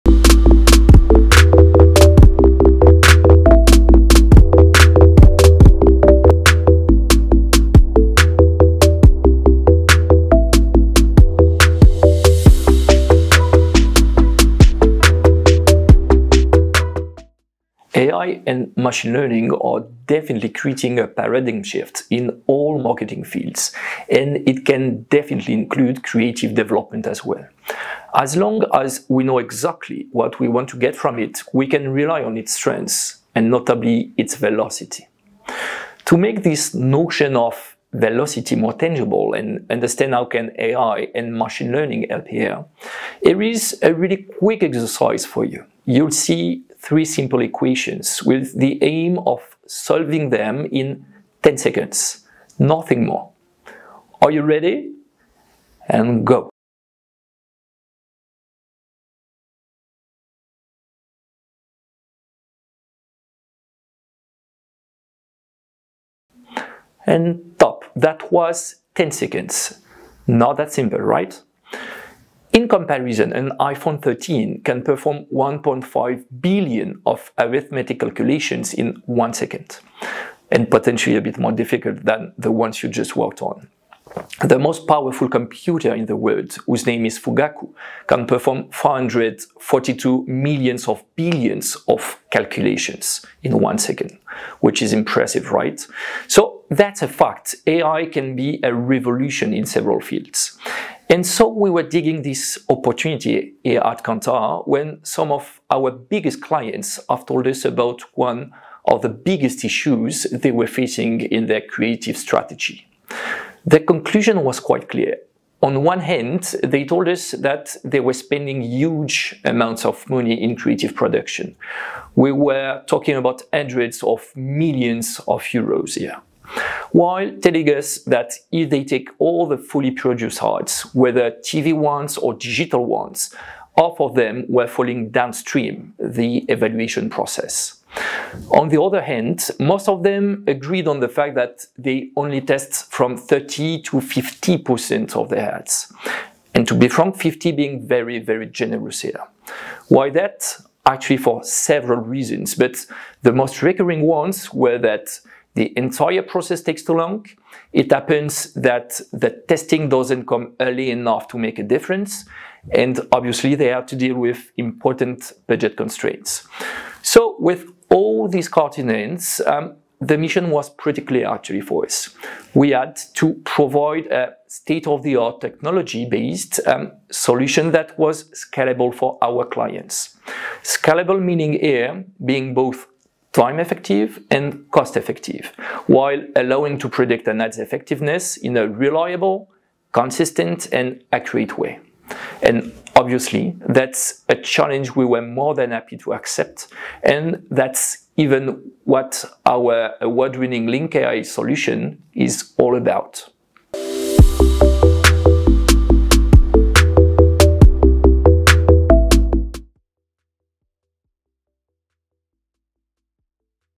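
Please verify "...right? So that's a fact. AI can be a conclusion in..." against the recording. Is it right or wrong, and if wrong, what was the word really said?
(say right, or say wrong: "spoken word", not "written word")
wrong: "revolution", not "conclusion".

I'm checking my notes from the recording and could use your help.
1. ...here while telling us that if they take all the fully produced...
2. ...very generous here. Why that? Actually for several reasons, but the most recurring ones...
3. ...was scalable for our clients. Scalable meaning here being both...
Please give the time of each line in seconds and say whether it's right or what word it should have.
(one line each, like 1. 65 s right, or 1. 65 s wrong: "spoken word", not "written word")
1. 125 s right
2. 148 s right
3. 177 s right.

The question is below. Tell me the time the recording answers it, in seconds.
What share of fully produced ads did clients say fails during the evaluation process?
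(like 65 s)
133 s.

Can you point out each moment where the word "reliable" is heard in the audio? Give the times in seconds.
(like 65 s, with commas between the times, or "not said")
188 s.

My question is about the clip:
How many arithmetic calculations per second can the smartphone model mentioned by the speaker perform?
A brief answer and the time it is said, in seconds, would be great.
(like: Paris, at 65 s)
1.5 billion, at 75 s.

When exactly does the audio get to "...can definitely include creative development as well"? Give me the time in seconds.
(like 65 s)
24 s.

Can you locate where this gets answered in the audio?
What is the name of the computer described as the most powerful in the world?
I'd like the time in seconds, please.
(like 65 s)
87 s.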